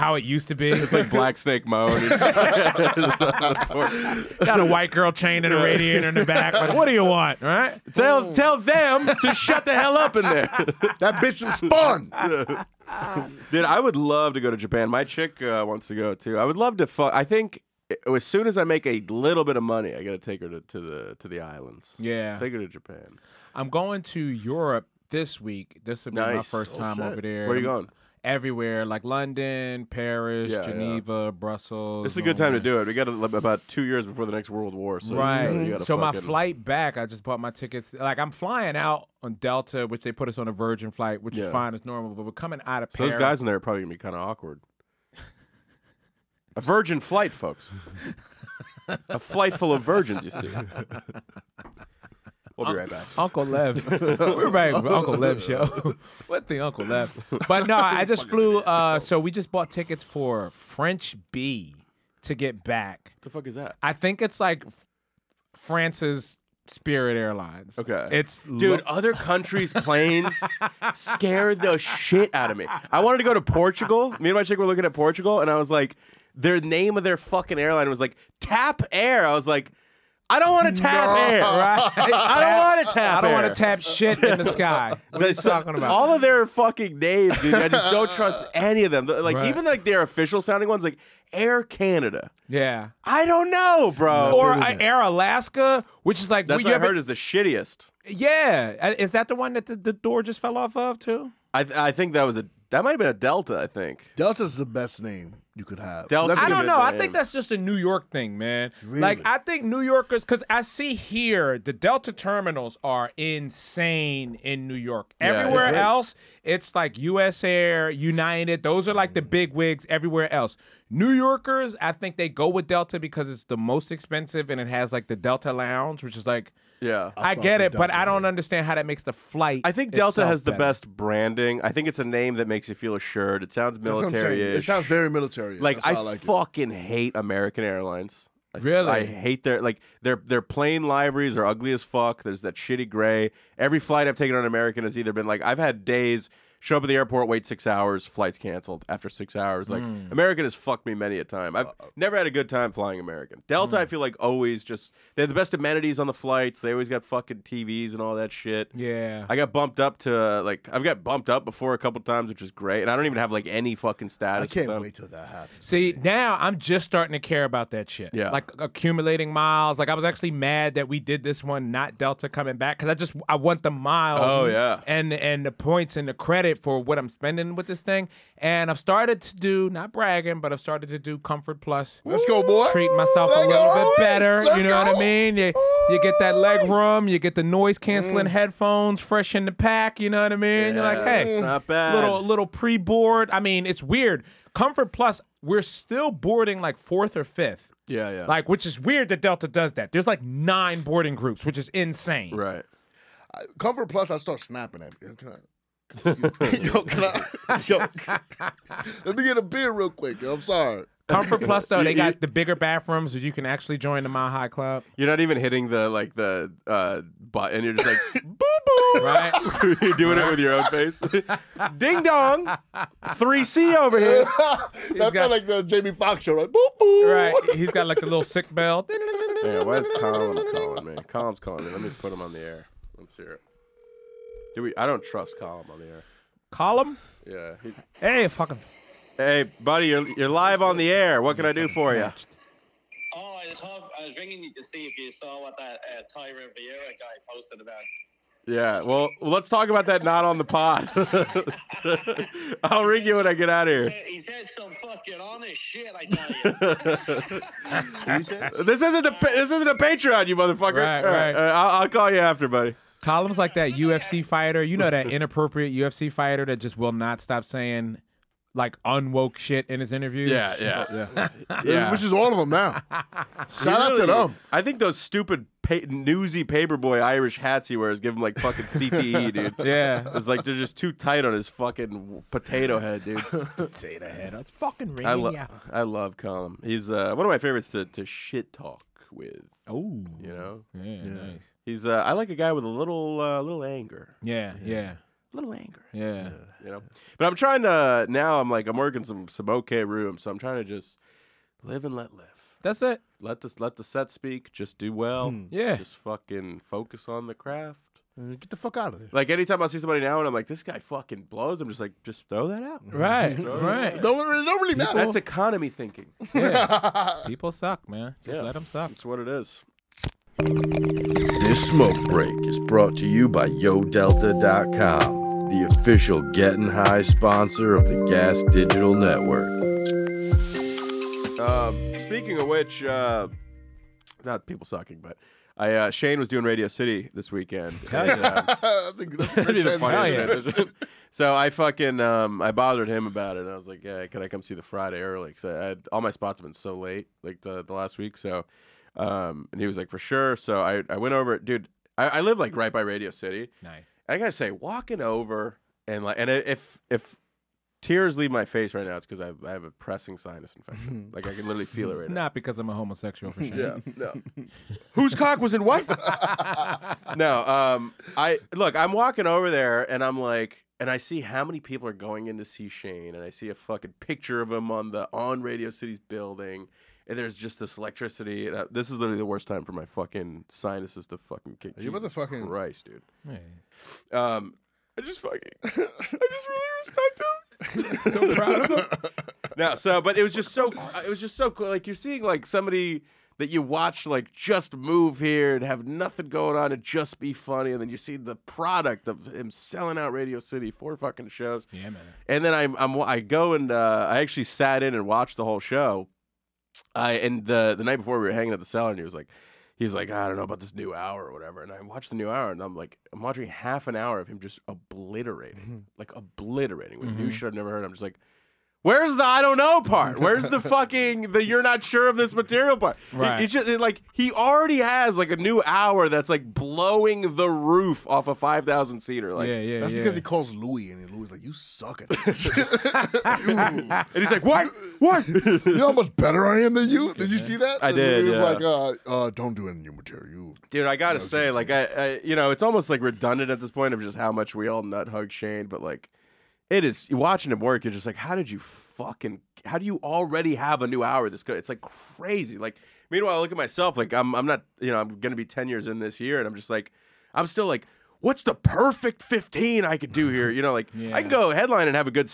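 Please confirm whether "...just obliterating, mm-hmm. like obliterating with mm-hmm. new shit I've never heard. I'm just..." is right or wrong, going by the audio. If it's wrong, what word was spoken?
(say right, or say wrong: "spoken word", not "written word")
right.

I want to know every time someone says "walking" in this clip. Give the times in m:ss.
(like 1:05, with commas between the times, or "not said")
5:54, 6:08.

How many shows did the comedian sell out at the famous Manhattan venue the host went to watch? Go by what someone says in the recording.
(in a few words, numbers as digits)
4.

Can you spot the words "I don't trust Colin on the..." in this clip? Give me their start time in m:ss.
3:54.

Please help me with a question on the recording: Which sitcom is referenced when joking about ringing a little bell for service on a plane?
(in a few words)
The Jamie Foxx Show.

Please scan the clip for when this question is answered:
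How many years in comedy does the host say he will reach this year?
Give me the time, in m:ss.
7:35.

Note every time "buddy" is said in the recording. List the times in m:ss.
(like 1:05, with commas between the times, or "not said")
3:59, 4:22.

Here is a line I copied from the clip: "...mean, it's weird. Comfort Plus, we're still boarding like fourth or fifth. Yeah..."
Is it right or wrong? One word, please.
right.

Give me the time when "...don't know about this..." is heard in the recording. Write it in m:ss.
6:50.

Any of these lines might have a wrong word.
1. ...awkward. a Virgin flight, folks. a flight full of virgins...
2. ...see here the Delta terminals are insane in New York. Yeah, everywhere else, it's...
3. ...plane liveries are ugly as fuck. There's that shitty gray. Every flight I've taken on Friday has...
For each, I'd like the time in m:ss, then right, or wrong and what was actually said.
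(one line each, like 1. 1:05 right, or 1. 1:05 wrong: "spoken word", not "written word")
1. 0:44 right
2. 1:50 right
3. 2:20 wrong: "American", not "Friday".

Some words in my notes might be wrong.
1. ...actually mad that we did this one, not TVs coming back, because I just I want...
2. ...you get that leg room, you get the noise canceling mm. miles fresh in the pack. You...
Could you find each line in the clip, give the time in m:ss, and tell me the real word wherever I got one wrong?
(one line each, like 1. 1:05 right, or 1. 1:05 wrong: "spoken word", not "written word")
1. 2:50 wrong: "Delta", not "TVs"
2. 3:05 wrong: "headphones", not "miles".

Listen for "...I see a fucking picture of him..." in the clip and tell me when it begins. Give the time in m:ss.
6:13.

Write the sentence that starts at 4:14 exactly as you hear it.
He said some fucking honest shit, I tell you.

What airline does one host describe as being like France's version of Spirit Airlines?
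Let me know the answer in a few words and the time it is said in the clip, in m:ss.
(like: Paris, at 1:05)
French Bee, at 1:00.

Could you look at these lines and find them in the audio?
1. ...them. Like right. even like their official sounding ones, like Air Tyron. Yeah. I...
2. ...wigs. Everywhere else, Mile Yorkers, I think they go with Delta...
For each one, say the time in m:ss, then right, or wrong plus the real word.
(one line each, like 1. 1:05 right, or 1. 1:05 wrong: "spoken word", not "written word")
1. 1:28 wrong: "Canada", not "Tyron"
2. 1:59 wrong: "New", not "Mile".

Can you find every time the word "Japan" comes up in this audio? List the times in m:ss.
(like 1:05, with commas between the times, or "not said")
0:14, 0:22.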